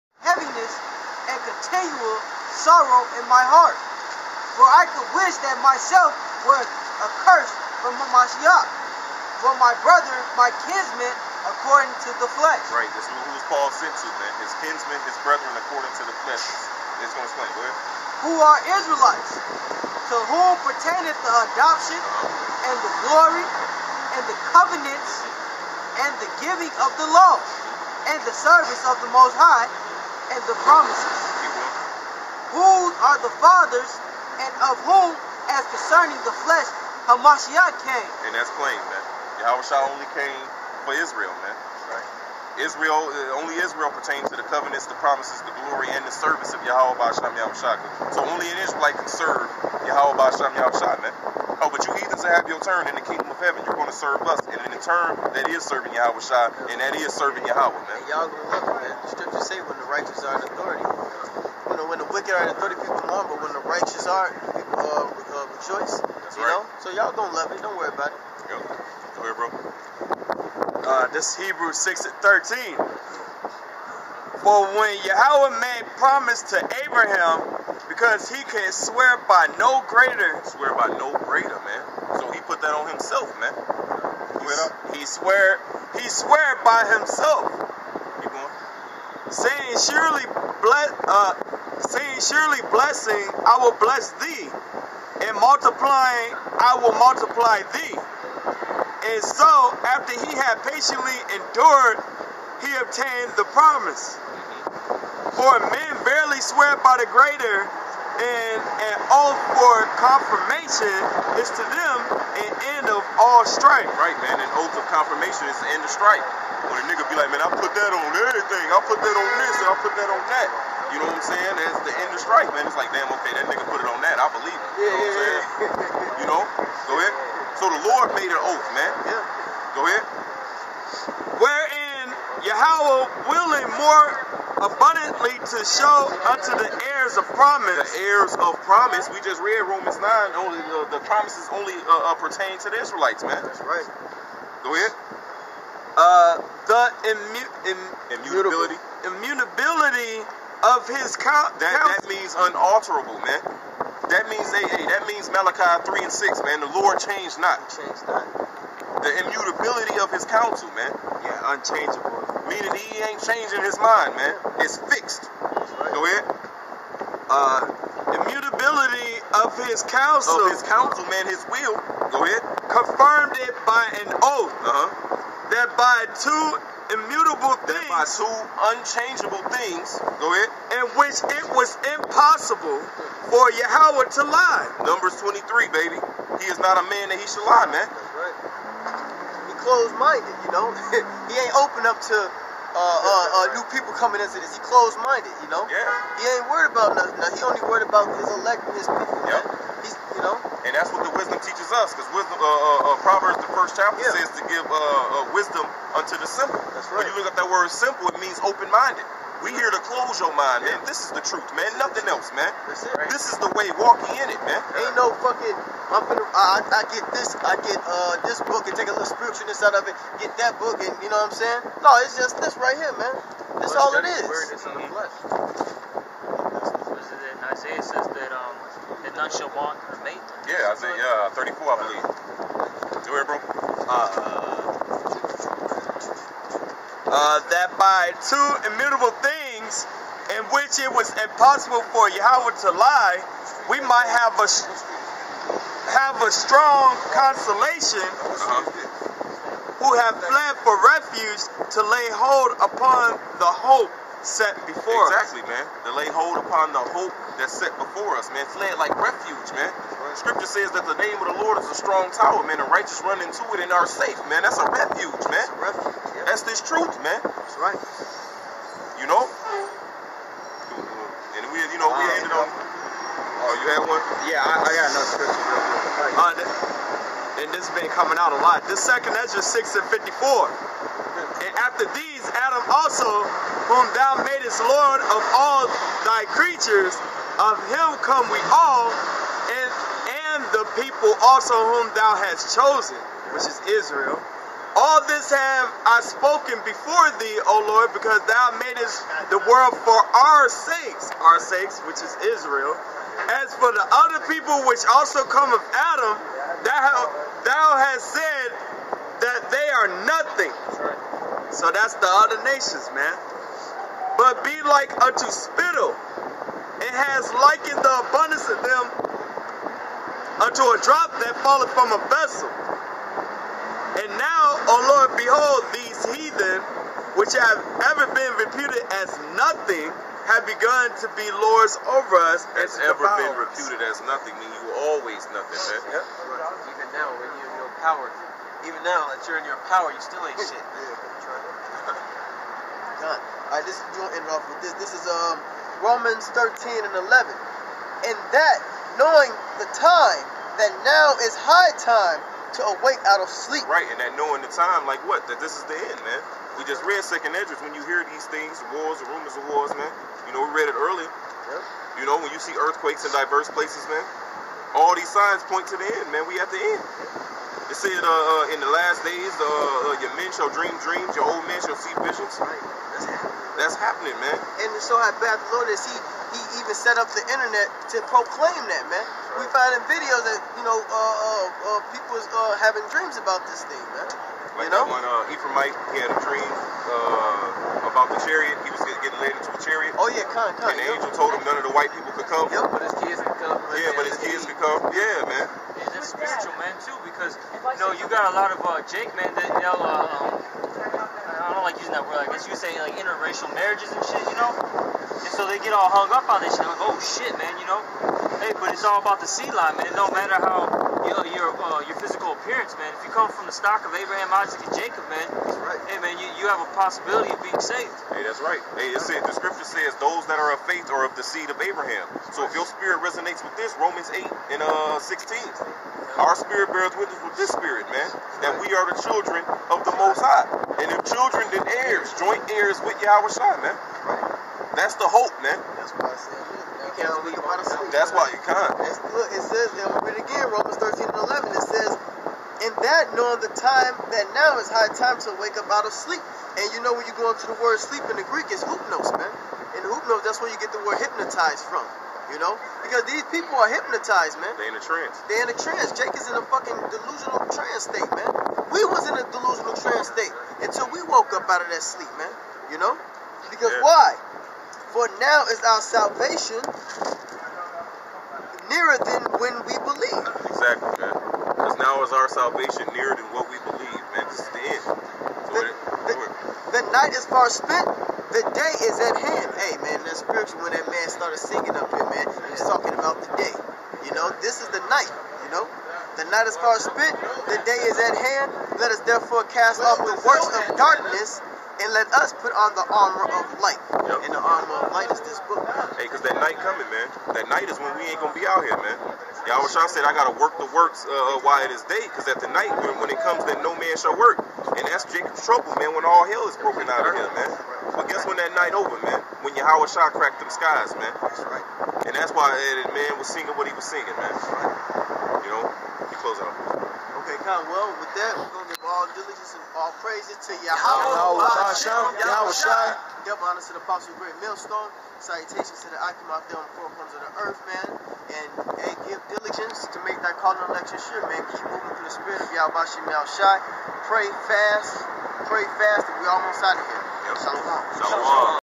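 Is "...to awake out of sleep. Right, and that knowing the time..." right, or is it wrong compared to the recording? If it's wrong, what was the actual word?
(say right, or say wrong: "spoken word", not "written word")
right.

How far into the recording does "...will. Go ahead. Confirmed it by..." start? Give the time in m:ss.
2:51.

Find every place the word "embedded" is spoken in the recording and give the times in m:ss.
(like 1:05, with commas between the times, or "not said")
not said.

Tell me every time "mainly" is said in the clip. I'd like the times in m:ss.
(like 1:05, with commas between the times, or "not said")
not said.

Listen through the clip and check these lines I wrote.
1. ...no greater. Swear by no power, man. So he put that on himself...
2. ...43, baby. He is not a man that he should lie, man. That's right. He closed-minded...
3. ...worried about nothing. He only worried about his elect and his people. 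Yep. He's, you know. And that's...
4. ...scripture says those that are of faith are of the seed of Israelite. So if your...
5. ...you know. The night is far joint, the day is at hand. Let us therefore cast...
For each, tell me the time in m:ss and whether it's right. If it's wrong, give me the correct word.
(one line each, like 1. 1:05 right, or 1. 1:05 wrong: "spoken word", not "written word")
1. 1:19 wrong: "greater", not "power"
2. 3:05 wrong: "23", not "43"
3. 3:16 right
4. 6:59 wrong: "Abraham", not "Israelite"
5. 8:05 wrong: "spent", not "joint".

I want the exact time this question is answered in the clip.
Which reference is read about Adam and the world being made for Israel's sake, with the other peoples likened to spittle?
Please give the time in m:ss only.
4:38.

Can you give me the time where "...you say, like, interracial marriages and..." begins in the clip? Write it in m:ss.
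6:42.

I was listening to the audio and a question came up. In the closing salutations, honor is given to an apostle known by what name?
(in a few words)
Great Millstone.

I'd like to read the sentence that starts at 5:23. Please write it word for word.
And now, O Lord, behold, these heathen, which have ever been reputed as nothing, have begun to be lords over us.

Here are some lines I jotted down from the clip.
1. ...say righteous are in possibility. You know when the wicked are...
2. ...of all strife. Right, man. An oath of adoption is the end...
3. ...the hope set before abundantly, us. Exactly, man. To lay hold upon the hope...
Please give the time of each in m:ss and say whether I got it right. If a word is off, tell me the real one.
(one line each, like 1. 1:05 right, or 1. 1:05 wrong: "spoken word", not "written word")
1. 0:59 wrong: "authority", not "possibility"
2. 1:52 wrong: "confirmation", not "adoption"
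3. 4:13 wrong: "exactly", not "abundantly".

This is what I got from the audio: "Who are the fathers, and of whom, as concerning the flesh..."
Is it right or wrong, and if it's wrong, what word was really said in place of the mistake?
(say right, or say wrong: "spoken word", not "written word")
right.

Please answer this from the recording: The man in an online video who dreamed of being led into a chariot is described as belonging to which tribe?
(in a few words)
Ephraimite.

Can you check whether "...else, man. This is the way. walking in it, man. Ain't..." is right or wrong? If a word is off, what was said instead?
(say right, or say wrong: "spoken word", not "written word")
right.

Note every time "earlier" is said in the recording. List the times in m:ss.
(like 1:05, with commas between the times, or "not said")
6:00.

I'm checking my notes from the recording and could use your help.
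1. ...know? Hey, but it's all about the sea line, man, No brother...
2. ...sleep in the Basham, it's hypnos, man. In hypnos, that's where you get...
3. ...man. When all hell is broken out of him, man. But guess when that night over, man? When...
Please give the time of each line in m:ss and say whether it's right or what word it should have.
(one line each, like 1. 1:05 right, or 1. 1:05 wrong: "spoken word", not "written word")
1. 6:47 wrong: "matter", not "brother"
2. 7:27 wrong: "Greek", not "Basham"
3. 8:25 right.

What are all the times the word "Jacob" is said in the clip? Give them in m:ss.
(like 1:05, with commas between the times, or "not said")
6:54, 8:25.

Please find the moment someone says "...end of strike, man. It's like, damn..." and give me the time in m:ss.
2:01.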